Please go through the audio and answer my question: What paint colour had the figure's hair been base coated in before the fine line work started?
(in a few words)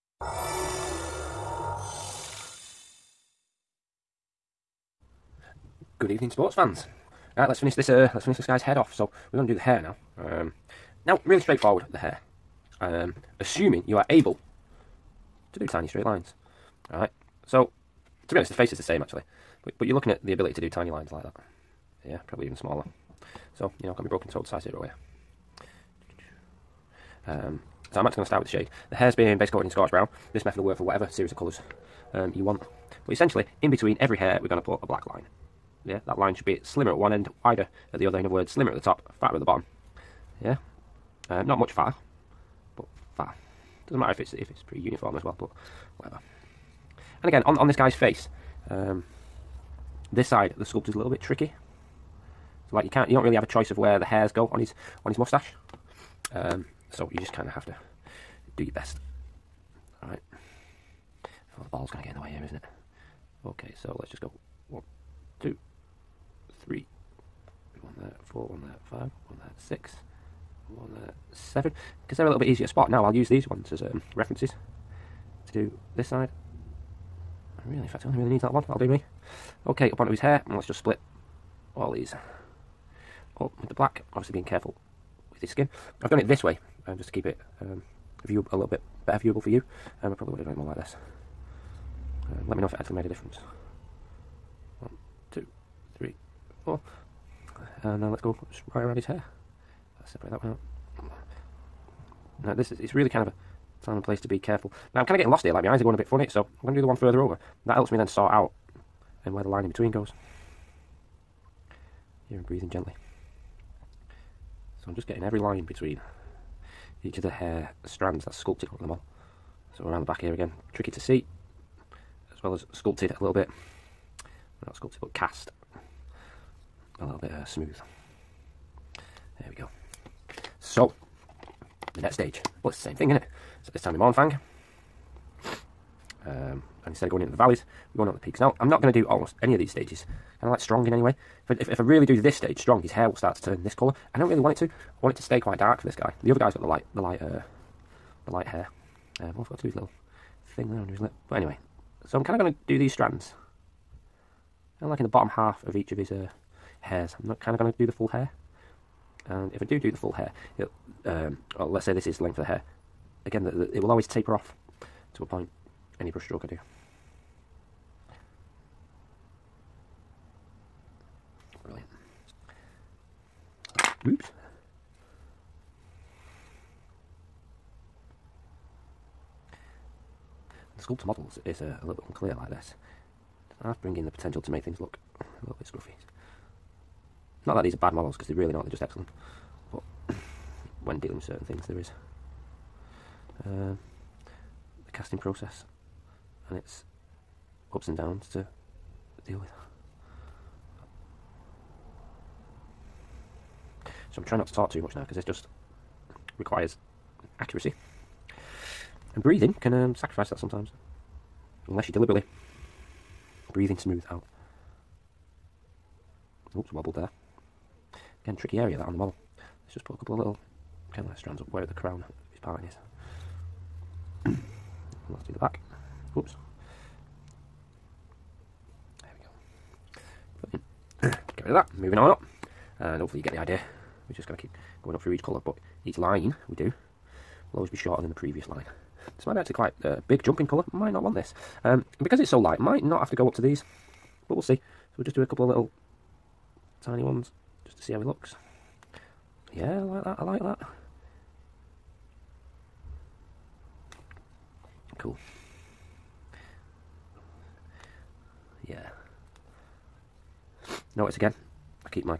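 Scorched Brown.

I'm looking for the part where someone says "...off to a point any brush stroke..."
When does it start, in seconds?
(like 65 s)
164 s.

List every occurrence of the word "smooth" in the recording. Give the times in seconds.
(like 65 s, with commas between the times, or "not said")
127 s, 213 s.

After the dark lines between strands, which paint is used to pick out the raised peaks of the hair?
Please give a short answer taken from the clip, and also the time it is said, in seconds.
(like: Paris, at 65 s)
Mournfang, at 133 s.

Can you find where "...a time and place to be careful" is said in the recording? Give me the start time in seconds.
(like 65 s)
103 s.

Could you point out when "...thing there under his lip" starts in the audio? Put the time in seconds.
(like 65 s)
150 s.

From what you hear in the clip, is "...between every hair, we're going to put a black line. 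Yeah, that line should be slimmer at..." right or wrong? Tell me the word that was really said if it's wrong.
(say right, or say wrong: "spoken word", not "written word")
right.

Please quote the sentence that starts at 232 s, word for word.
And hopefully you get the idea.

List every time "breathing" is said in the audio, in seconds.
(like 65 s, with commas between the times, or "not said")
112 s, 209 s, 213 s.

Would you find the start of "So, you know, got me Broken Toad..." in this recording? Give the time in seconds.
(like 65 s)
23 s.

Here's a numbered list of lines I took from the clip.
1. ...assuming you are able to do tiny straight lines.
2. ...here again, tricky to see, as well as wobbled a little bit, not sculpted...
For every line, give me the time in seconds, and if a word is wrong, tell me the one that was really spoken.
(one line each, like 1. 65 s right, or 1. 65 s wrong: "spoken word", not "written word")
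1. 13 s right
2. 120 s wrong: "sculpted", not "wobbled".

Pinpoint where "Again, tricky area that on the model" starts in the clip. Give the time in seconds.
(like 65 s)
218 s.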